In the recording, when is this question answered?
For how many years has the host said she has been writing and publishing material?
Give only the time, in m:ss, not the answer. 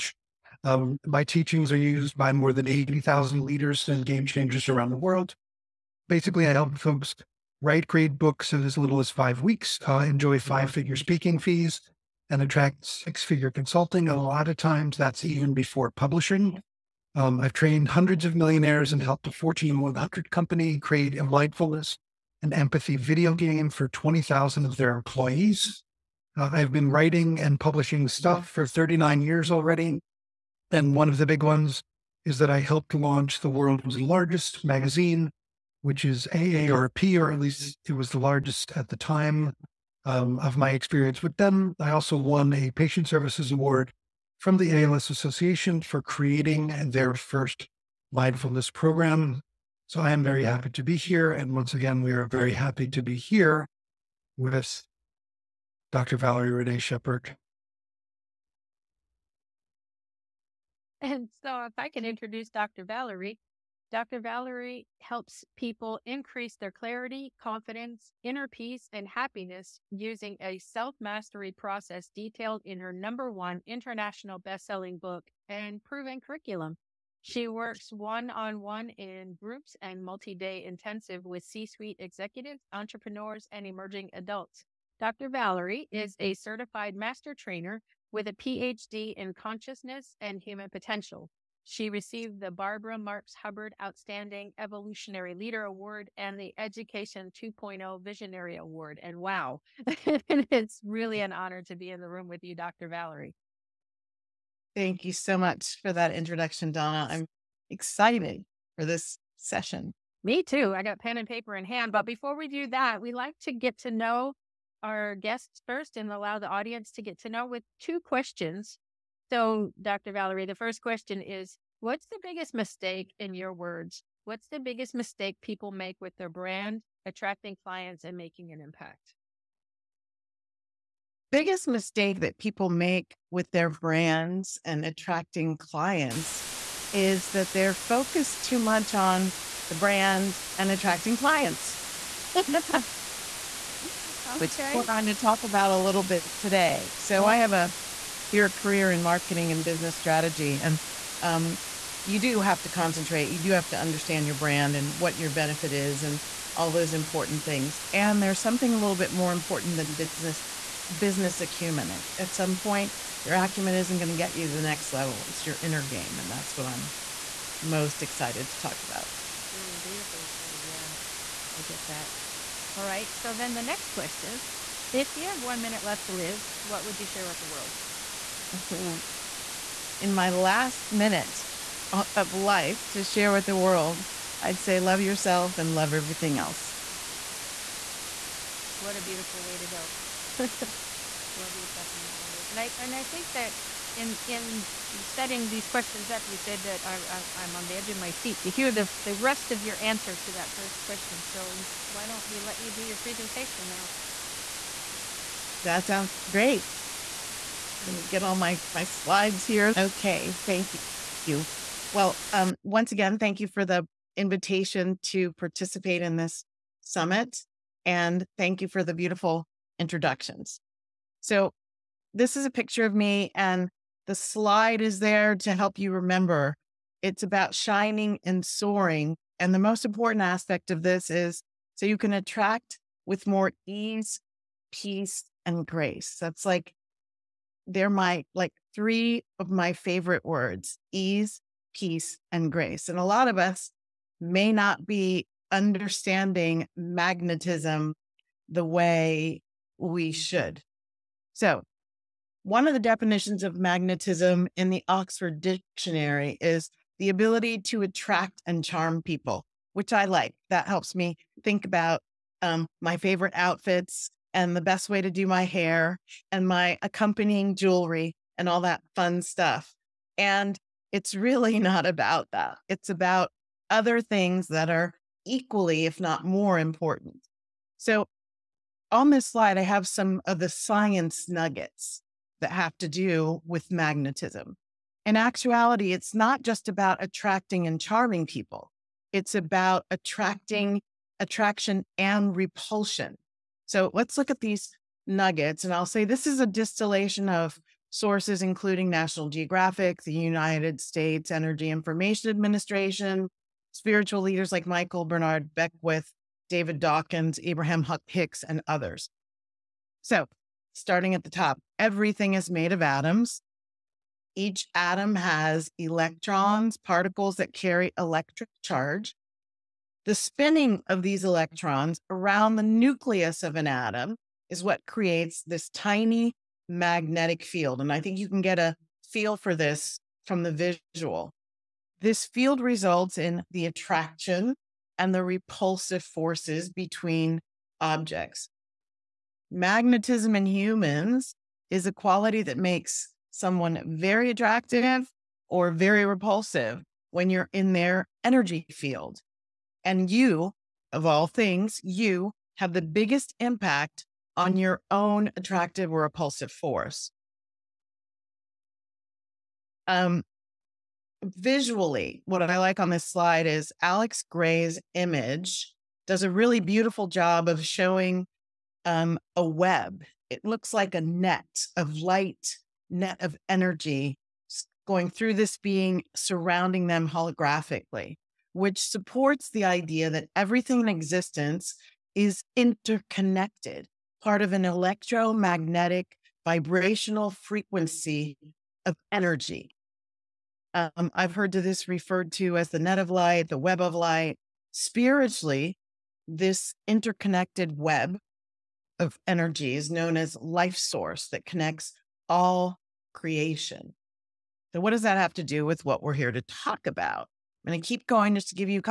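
0:28.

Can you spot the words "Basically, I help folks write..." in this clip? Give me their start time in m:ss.
0:06.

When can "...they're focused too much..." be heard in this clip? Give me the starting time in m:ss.
2:17.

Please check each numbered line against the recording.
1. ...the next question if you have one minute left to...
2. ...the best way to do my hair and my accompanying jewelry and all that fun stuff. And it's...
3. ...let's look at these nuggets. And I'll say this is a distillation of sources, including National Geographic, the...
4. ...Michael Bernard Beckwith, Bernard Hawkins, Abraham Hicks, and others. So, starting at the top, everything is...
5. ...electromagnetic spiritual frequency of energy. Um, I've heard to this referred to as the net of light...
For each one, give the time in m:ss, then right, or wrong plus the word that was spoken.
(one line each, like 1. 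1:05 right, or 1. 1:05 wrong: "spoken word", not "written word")
1. 2:53 right
2. 4:24 right
3. 4:53 right
4. 5:04 wrong: "David", not "Bernard"
5. 6:24 wrong: "vibrational", not "spiritual".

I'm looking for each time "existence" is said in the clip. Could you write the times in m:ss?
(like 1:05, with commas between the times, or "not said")
6:20.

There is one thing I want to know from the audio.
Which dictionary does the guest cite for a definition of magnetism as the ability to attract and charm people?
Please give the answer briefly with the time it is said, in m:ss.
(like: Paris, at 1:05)
Oxford Dictionary, at 4:14.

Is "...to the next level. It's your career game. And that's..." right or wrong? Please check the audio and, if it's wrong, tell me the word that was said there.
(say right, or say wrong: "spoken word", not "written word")
wrong: "inner", not "career".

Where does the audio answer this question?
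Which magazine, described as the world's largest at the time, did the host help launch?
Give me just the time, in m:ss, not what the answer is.
0:36.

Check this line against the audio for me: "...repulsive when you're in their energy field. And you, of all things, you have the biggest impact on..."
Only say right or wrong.
right.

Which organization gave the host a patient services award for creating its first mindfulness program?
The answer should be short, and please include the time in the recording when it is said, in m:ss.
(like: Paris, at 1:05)
ALS Association, at 0:44.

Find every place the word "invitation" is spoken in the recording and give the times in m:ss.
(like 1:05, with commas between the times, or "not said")
3:34.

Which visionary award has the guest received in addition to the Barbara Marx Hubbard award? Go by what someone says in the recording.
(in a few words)
Education 2.0 Visionary Award.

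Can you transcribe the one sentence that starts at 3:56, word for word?
That's like they're my like three of my favorite words ease, peace, and grace.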